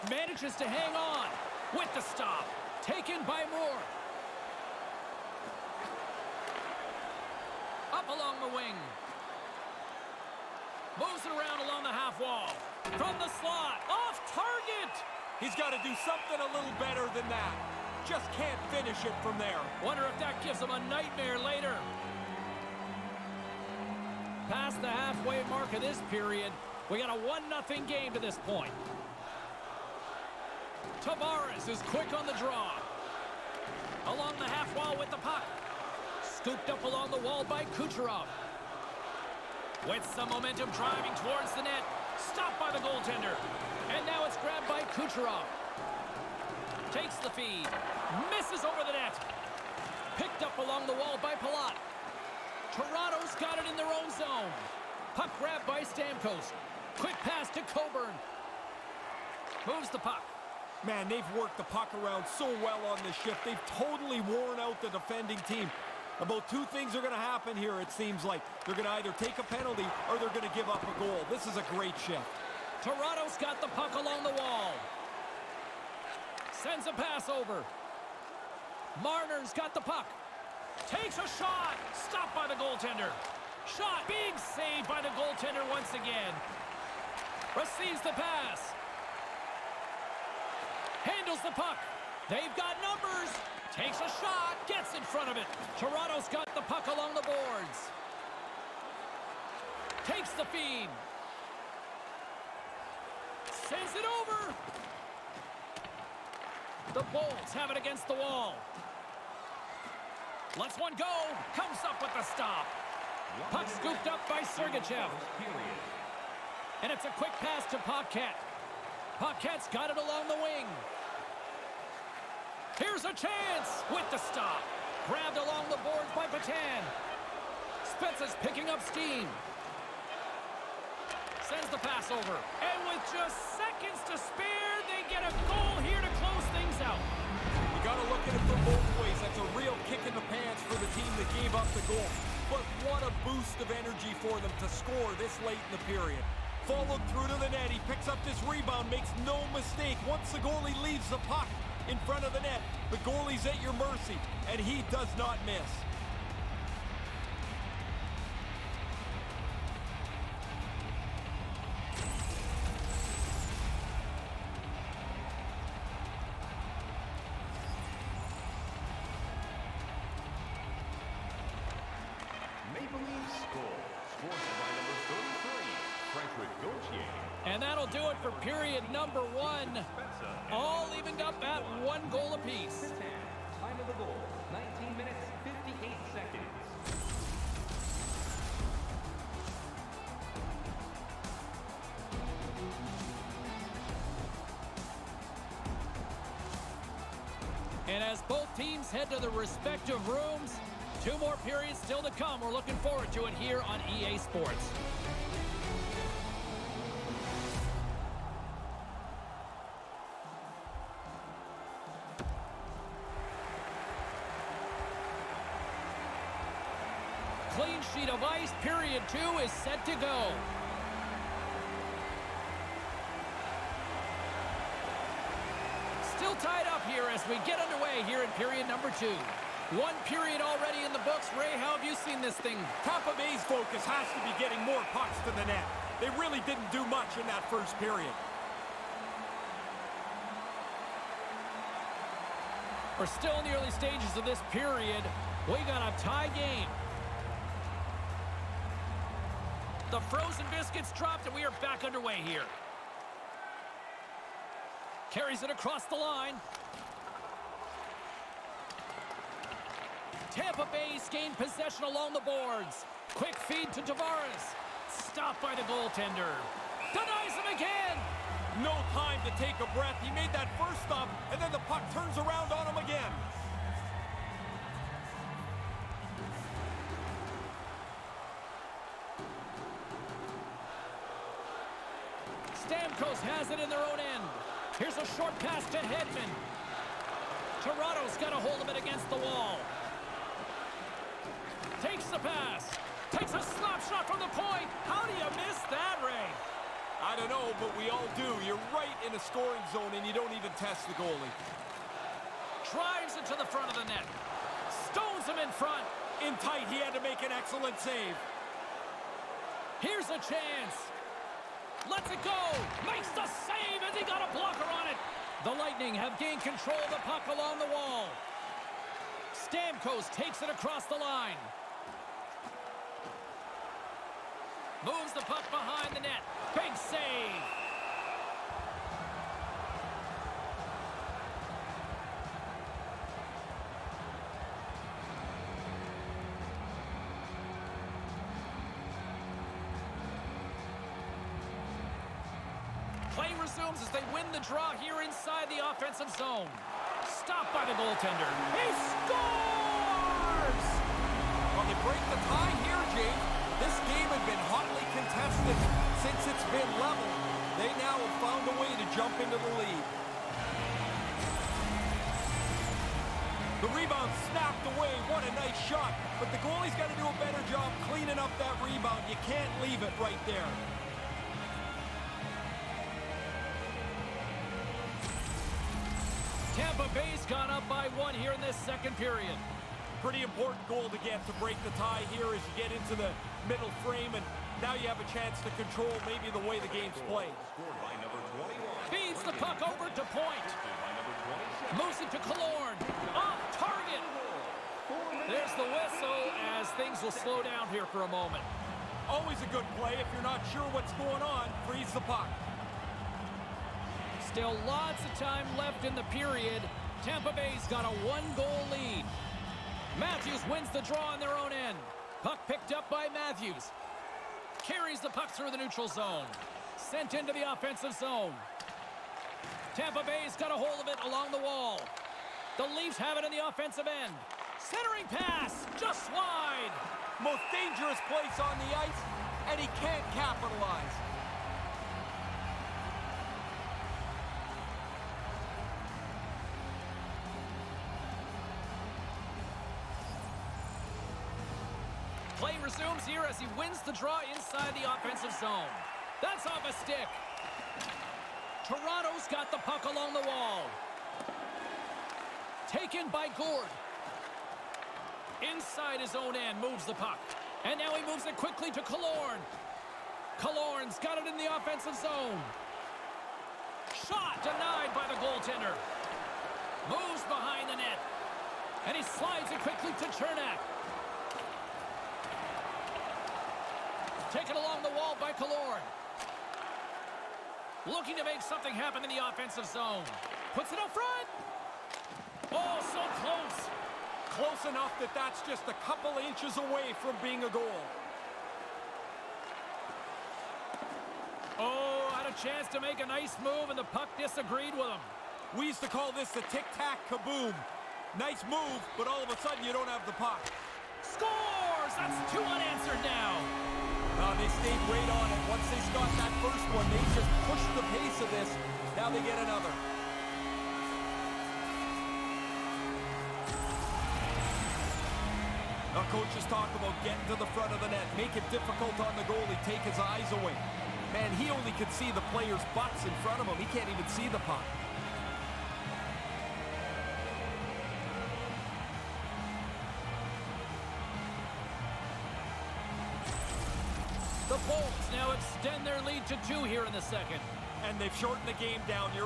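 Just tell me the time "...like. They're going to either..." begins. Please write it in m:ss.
1:08.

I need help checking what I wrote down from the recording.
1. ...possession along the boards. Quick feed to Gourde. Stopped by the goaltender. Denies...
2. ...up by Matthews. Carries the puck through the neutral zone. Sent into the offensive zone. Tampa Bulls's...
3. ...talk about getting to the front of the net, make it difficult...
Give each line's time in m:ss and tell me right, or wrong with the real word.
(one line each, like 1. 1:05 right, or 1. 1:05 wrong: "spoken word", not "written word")
1. 4:21 wrong: "Tavares", not "Gourde"
2. 6:52 wrong: "Bay", not "Bulls"
3. 8:36 right.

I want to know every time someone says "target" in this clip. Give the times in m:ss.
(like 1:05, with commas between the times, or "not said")
0:14, 6:33.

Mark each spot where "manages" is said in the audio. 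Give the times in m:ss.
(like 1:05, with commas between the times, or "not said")
0:00.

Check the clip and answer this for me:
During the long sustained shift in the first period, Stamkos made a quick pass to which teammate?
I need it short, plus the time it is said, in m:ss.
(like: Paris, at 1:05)
Coburn, at 0:57.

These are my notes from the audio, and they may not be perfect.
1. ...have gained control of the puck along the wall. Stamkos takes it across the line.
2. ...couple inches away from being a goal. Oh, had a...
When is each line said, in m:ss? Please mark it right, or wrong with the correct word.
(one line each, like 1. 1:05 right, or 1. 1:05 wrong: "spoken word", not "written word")
1. 5:15 right
2. 8:05 right.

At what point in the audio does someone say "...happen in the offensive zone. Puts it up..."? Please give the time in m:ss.
7:58.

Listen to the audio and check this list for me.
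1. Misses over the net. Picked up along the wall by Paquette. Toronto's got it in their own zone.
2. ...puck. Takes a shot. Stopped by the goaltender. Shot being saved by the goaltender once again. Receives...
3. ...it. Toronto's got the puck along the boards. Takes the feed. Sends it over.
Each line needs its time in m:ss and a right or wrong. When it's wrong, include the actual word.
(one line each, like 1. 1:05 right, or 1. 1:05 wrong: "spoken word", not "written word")
1. 0:48 wrong: "Palat", not "Paquette"
2. 1:19 right
3. 1:35 right.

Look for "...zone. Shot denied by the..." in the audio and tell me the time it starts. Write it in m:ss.
7:41.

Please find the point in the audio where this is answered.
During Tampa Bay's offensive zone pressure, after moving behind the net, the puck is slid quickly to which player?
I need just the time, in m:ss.
7:50.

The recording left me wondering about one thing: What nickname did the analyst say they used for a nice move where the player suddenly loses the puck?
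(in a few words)
the tic-tac-kaboom.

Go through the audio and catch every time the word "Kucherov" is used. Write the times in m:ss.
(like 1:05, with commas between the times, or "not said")
0:37, 0:44.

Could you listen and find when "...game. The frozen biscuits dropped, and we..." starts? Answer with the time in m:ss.
4:06.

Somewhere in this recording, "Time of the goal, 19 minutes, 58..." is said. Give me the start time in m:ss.
3:03.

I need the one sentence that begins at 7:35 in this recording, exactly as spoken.
Inside his own end, moves the puck.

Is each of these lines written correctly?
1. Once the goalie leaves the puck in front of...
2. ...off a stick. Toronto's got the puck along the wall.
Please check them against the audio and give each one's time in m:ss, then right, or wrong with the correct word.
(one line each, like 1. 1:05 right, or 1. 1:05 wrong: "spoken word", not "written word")
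1. 2:30 right
2. 7:26 right.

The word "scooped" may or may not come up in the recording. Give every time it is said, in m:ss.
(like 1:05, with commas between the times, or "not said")
0:36, 1:53.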